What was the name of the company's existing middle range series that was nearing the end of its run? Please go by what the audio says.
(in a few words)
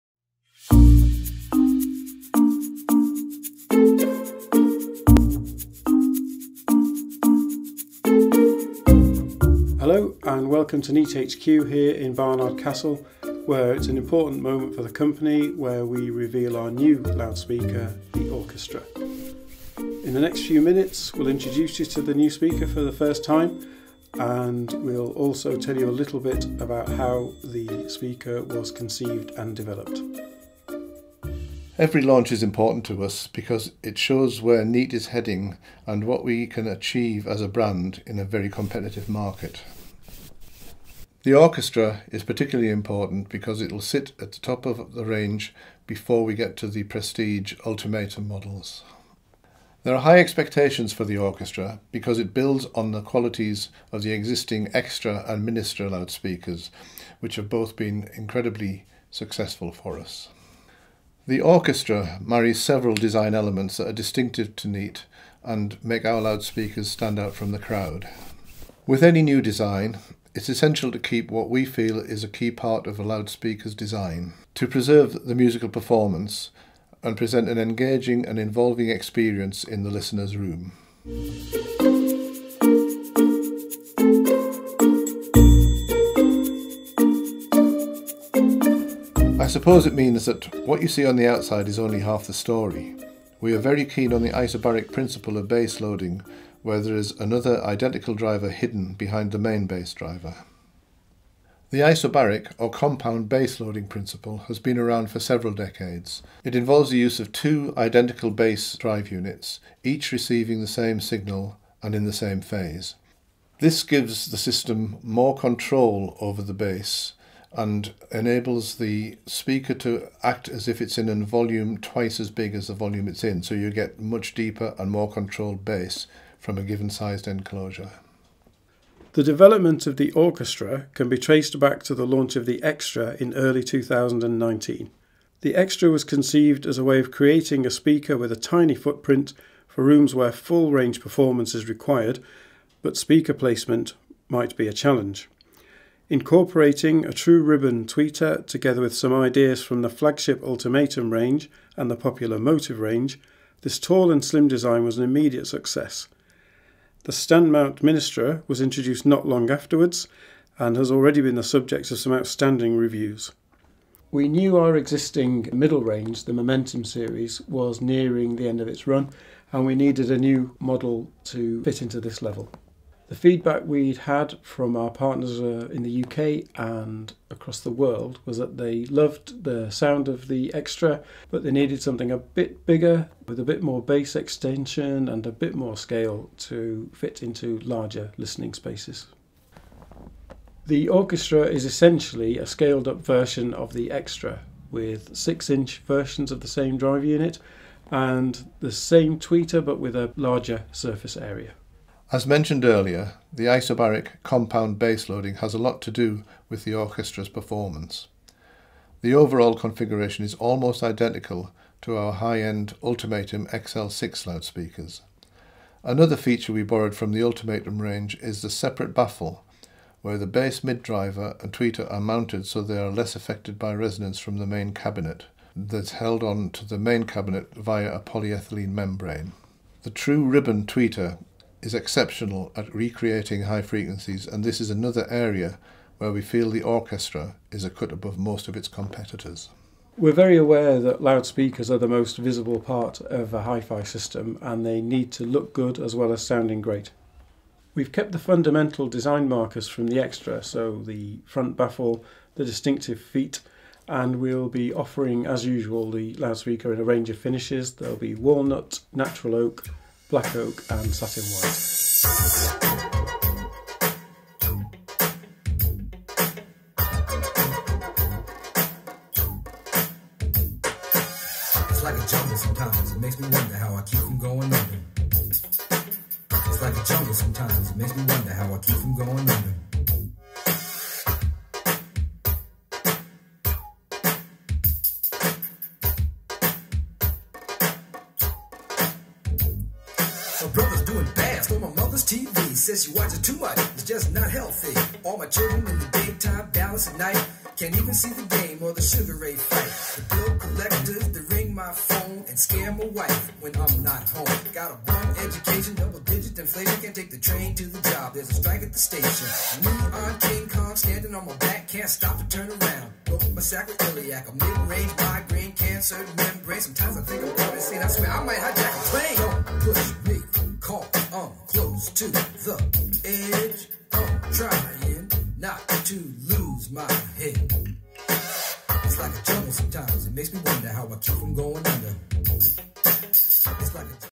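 Momentum.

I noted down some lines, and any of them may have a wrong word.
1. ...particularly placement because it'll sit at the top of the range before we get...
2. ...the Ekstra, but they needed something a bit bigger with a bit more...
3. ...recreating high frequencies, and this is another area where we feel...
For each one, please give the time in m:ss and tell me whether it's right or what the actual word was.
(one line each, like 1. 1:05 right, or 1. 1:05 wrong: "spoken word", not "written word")
1. 0:42 wrong: "important", not "placement"
2. 3:00 right
3. 3:52 right.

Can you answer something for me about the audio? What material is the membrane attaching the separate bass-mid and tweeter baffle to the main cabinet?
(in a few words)
polyethylene.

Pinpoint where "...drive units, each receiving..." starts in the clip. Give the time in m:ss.
1:48.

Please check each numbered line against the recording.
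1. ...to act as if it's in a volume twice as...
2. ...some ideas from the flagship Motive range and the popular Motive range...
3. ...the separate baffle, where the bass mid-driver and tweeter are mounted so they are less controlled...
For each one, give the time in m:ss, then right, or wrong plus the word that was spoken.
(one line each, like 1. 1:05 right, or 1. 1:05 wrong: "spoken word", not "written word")
1. 1:59 right
2. 2:28 wrong: "Ultimatum", not "Motive"
3. 3:38 wrong: "affected", not "controlled".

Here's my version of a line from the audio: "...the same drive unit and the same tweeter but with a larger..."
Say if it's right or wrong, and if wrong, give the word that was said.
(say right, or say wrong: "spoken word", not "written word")
right.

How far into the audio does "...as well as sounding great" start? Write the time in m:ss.
4:05.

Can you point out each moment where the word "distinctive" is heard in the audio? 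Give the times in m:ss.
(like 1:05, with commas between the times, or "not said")
1:03, 4:12.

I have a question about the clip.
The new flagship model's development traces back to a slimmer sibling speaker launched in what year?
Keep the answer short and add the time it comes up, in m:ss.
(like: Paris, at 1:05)
2019, at 2:13.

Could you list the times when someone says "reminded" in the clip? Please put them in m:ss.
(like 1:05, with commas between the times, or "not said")
not said.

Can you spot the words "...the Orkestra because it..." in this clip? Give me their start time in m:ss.
0:51.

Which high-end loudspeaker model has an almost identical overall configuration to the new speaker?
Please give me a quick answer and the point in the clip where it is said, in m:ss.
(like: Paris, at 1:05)
Ultimatum XL6, at 3:32.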